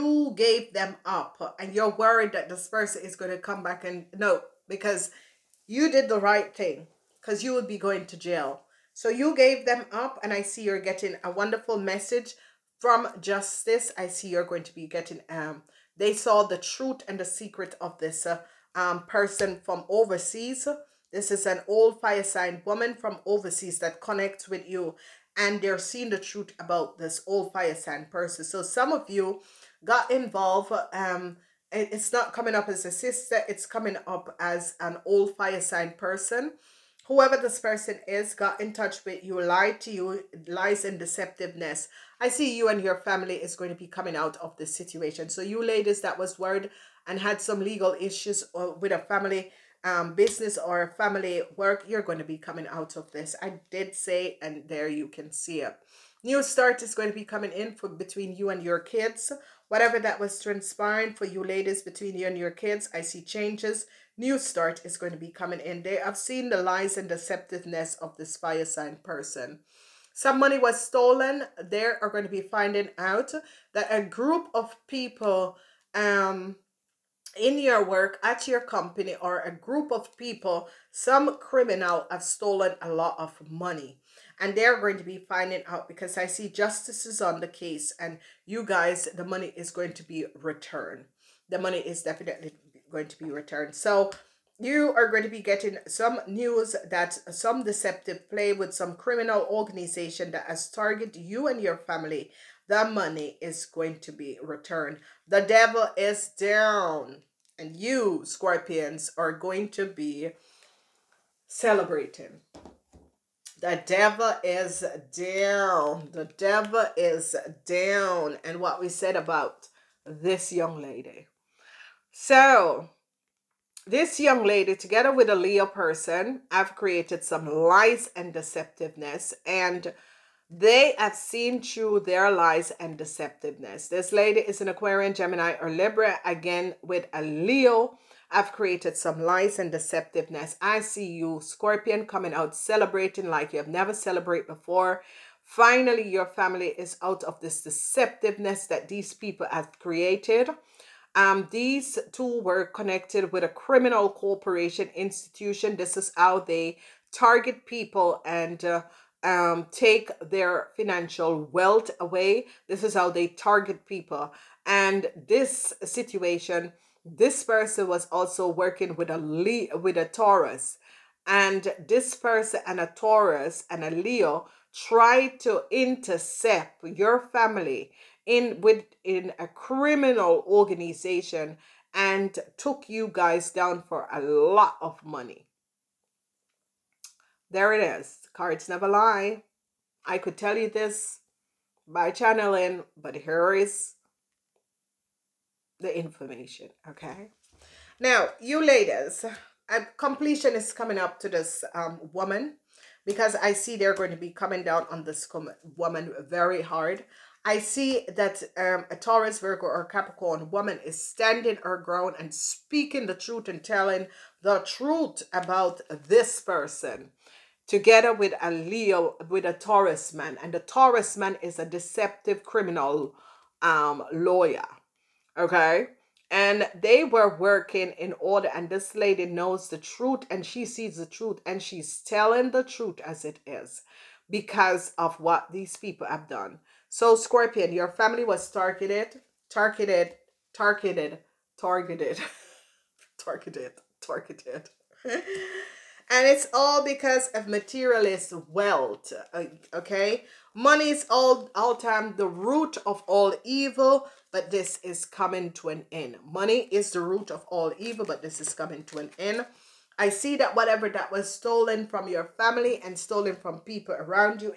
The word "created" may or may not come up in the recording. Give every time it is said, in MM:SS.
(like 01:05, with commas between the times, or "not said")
02:06, 02:18, 02:29.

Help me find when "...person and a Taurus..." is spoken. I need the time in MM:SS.
02:52.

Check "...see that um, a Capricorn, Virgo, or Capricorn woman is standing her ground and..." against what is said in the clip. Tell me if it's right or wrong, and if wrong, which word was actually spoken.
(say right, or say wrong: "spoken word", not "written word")
wrong: "Taurus", not "Capricorn".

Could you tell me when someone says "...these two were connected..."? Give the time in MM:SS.
02:31.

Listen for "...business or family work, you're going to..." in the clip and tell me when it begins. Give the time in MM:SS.
00:50.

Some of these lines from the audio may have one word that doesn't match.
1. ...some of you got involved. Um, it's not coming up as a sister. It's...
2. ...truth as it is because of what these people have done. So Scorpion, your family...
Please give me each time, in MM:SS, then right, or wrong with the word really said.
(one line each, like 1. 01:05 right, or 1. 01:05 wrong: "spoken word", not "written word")
1. 00:28 right
2. 03:52 right.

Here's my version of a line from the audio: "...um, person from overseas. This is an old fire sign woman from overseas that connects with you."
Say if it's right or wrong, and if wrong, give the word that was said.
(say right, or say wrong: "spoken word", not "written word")
right.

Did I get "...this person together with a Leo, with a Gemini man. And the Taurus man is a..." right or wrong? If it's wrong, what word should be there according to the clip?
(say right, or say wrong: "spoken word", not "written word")
wrong: "Taurus", not "Gemini".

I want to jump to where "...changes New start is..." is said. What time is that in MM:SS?
01:03.